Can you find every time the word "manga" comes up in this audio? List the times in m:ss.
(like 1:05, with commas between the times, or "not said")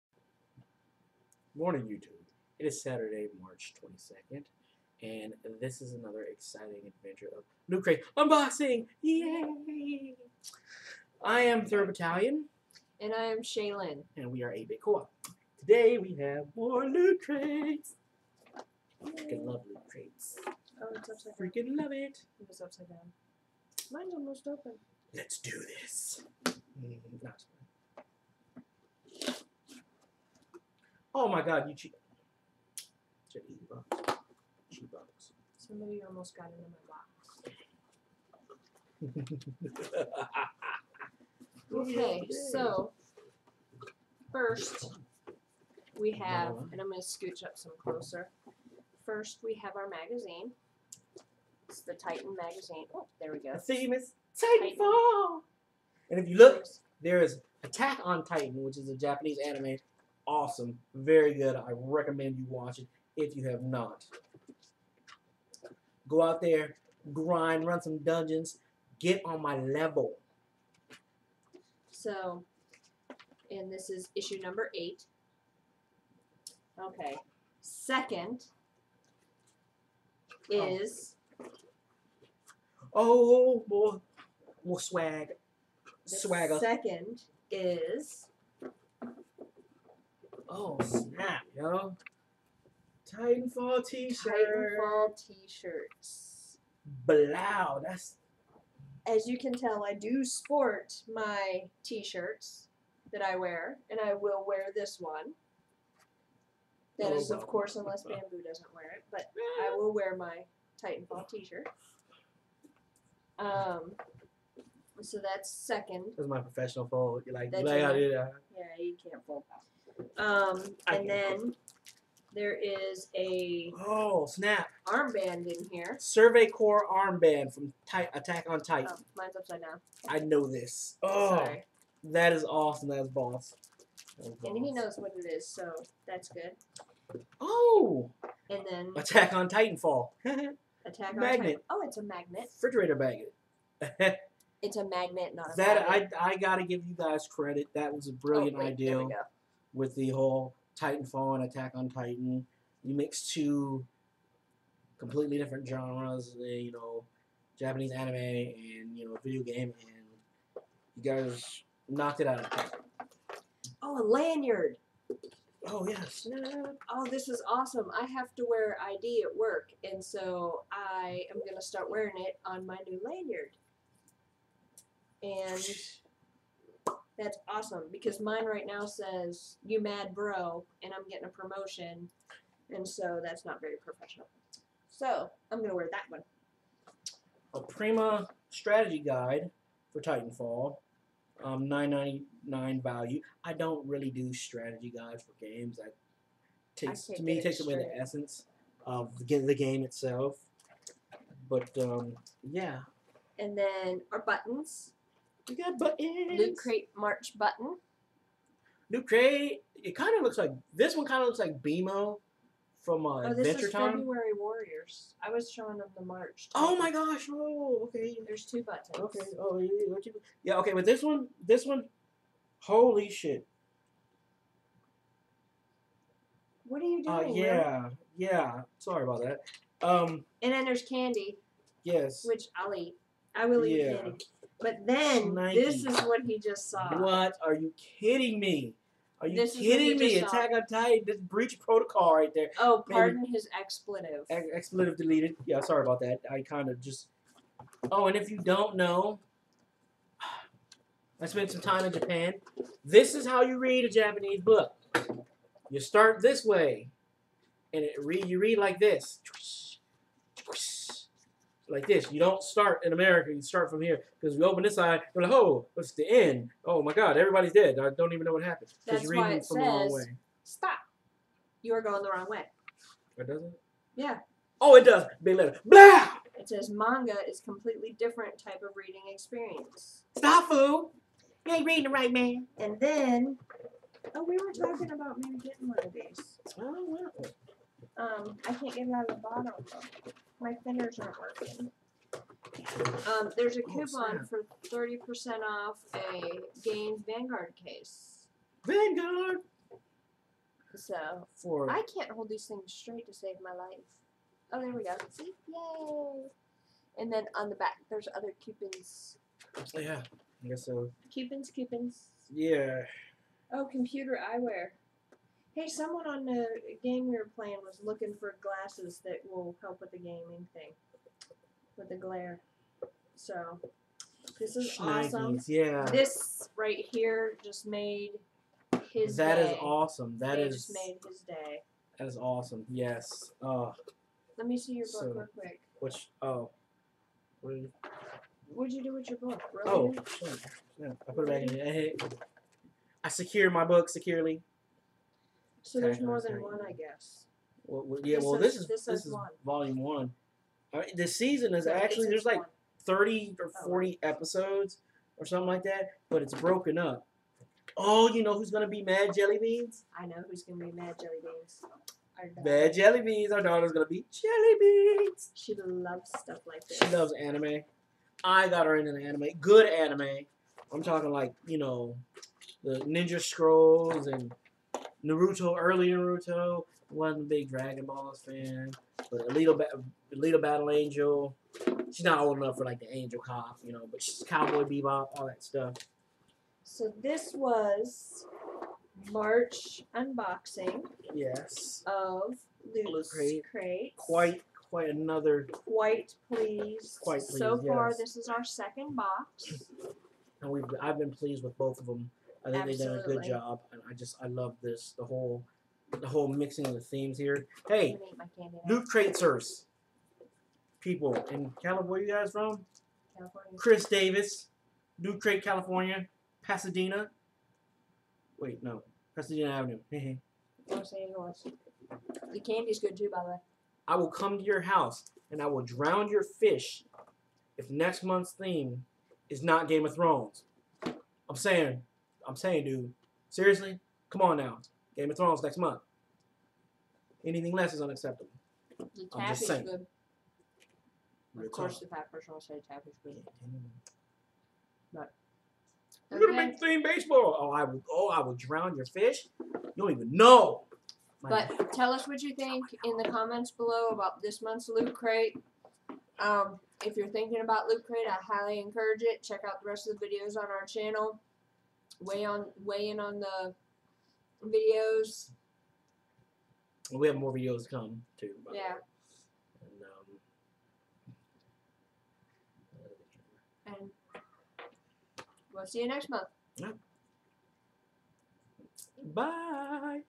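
4:36.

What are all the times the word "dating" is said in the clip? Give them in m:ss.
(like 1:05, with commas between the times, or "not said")
not said.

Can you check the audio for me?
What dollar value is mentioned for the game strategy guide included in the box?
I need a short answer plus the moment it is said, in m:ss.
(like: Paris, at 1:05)
$9.99, at 3:11.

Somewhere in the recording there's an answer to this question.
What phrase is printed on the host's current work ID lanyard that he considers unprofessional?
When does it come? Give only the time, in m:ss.
2:59.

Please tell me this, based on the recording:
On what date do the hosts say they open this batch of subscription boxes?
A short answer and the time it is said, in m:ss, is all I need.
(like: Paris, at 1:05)
March 22nd, at 0:03.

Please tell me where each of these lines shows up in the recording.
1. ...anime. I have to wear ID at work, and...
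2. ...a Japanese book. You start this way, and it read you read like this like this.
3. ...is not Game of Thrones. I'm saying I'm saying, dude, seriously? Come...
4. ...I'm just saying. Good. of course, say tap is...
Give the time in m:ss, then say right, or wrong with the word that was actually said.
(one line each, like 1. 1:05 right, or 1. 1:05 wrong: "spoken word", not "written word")
1. 2:47 wrong: "awesome", not "anime"
2. 4:13 right
3. 7:09 right
4. 7:19 right.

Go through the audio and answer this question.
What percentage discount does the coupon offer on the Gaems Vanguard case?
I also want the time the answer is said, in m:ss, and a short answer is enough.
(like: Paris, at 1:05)
30%, at 4:54.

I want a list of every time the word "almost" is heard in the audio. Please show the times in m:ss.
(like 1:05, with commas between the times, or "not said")
0:24, 0:36.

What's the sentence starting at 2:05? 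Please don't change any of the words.
Survey Corps armband from Ty Attack on Titan.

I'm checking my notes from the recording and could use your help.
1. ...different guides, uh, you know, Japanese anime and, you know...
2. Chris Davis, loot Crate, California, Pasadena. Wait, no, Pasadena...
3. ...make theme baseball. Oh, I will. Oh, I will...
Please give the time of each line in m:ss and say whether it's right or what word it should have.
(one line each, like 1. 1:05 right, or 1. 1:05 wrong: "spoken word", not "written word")
1. 2:35 wrong: "genres", not "guides"
2. 6:53 right
3. 7:26 right.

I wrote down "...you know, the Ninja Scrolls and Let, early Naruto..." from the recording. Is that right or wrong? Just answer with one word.
wrong.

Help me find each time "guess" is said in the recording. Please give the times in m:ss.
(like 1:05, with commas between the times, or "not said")
5:10, 5:46.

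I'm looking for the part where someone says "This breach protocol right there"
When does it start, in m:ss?
4:01.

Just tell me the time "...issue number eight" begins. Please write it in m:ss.
1:14.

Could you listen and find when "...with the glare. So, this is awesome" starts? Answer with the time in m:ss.
5:21.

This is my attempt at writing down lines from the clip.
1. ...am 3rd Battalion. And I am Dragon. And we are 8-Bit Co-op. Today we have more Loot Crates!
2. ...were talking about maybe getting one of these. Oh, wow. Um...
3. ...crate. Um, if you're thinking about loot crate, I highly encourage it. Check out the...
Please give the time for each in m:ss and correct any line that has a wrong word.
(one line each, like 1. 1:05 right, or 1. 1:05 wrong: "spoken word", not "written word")
1. 0:11 wrong: "Shaylin", not "Dragon"
2. 4:44 right
3. 7:34 right.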